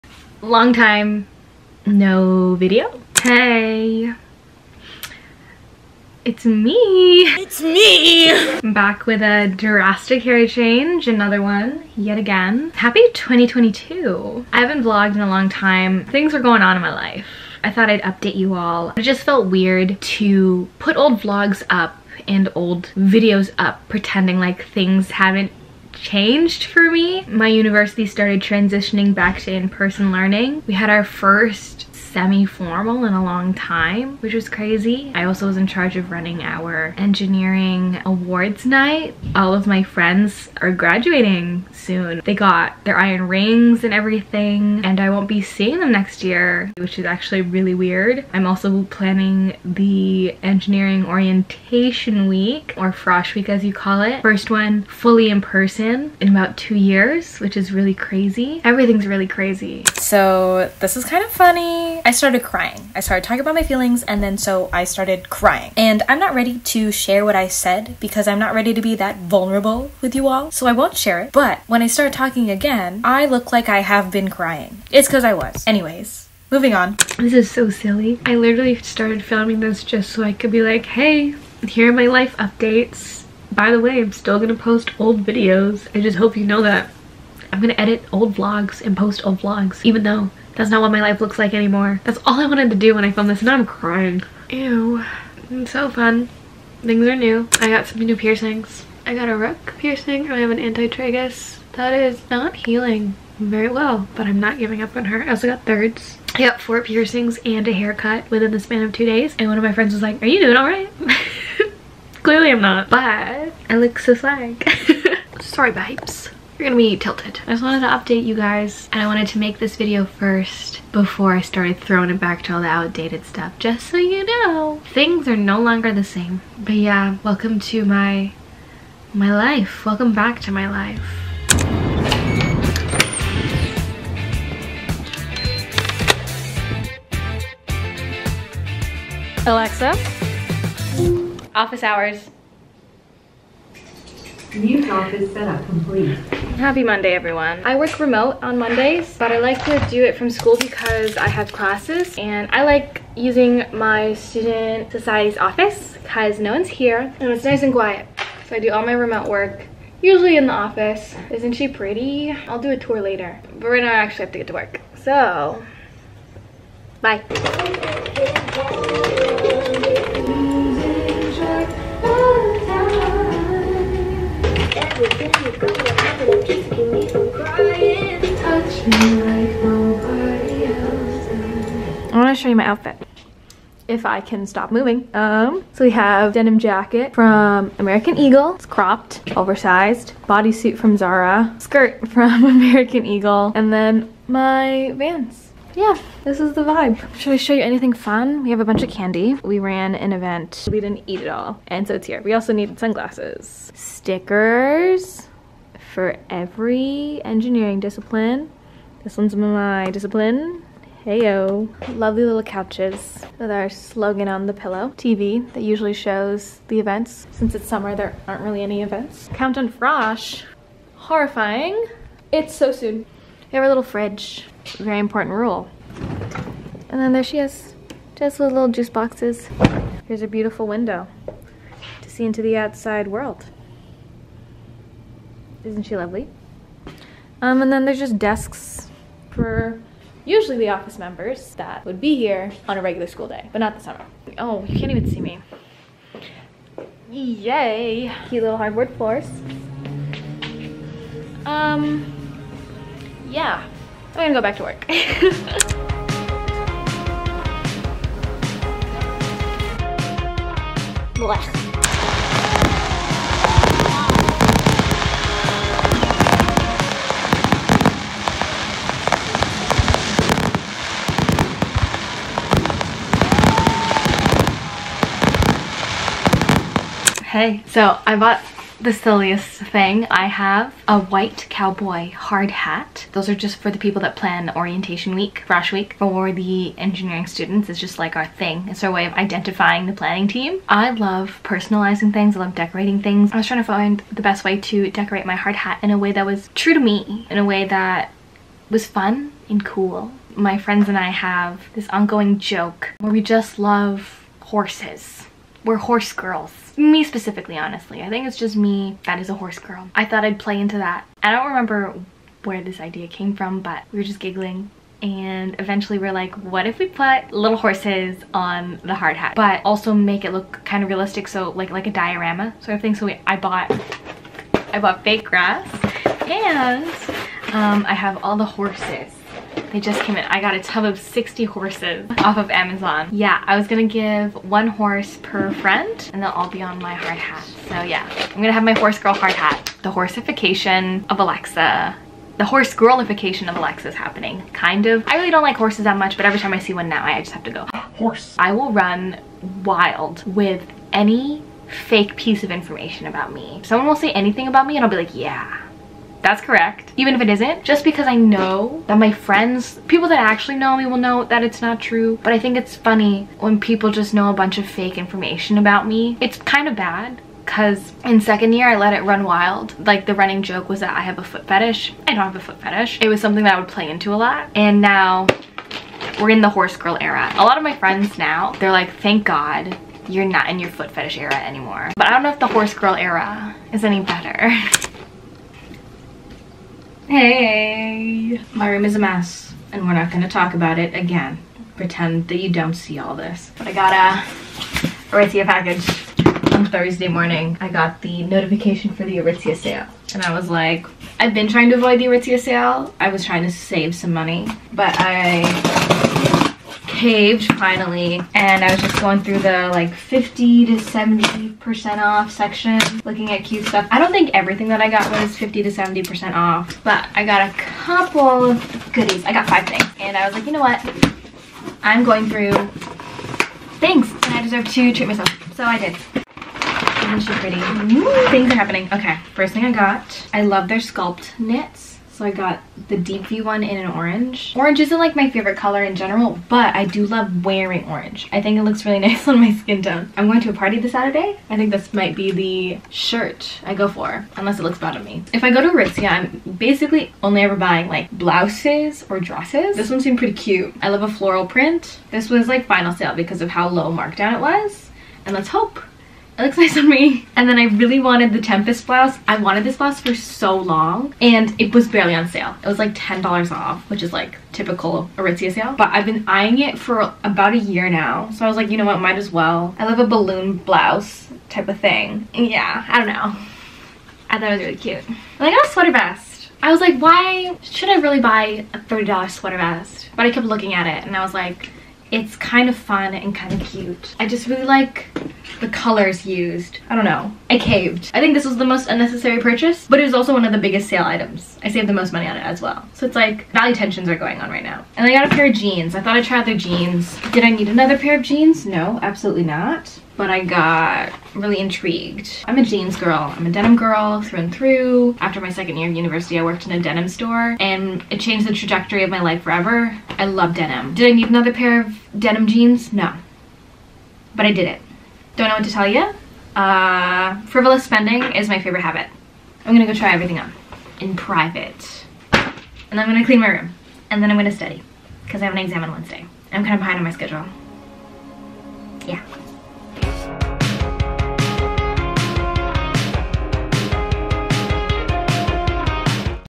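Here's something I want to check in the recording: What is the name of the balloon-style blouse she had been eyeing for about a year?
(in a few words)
Tempest.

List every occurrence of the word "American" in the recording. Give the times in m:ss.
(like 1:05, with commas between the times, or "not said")
3:07, 3:12.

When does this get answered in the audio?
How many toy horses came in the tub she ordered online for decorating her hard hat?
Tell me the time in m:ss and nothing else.
5:30.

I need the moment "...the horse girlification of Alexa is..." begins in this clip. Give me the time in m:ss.
5:42.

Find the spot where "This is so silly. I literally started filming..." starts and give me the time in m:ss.
1:17.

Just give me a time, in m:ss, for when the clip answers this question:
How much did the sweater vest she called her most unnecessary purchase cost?
7:58.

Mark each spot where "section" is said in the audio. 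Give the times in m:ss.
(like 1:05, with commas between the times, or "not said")
6:52.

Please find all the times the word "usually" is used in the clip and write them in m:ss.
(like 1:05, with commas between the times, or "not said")
2:40, 3:35, 4:00.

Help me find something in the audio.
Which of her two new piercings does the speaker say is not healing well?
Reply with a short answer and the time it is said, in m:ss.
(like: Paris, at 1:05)
anti-tragus, at 1:40.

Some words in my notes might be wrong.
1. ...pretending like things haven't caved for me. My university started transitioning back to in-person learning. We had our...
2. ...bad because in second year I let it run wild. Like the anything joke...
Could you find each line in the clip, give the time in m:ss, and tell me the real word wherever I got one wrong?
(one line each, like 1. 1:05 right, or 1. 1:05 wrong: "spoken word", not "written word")
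1. 0:23 wrong: "changed", not "caved"
2. 6:06 wrong: "running", not "anything".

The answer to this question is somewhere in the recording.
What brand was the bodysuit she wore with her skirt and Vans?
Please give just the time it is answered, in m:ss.
3:10.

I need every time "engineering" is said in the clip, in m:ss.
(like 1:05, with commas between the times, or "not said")
0:36, 0:50, 3:27, 4:46.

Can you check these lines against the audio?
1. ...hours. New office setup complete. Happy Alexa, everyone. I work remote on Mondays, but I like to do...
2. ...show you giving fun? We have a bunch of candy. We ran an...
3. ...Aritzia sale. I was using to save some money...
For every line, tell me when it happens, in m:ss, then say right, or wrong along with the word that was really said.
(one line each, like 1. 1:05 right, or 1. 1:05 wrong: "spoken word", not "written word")
1. 2:21 wrong: "Monday", not "Alexa"
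2. 3:17 wrong: "anything", not "giving"
3. 6:42 wrong: "trying", not "using".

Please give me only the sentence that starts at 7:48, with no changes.
So I was like, you know what, might as well.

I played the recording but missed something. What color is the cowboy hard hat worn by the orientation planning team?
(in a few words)
white.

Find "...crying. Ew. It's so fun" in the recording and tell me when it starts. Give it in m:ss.
1:33.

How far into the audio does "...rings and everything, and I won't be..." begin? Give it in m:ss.
0:43.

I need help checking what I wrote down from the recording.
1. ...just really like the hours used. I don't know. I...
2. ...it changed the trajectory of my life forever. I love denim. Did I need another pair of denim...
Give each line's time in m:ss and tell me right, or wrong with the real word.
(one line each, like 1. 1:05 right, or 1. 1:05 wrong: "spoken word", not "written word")
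1. 8:04 wrong: "colors", not "hours"
2. 8:28 right.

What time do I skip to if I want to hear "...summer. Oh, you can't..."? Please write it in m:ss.
4:03.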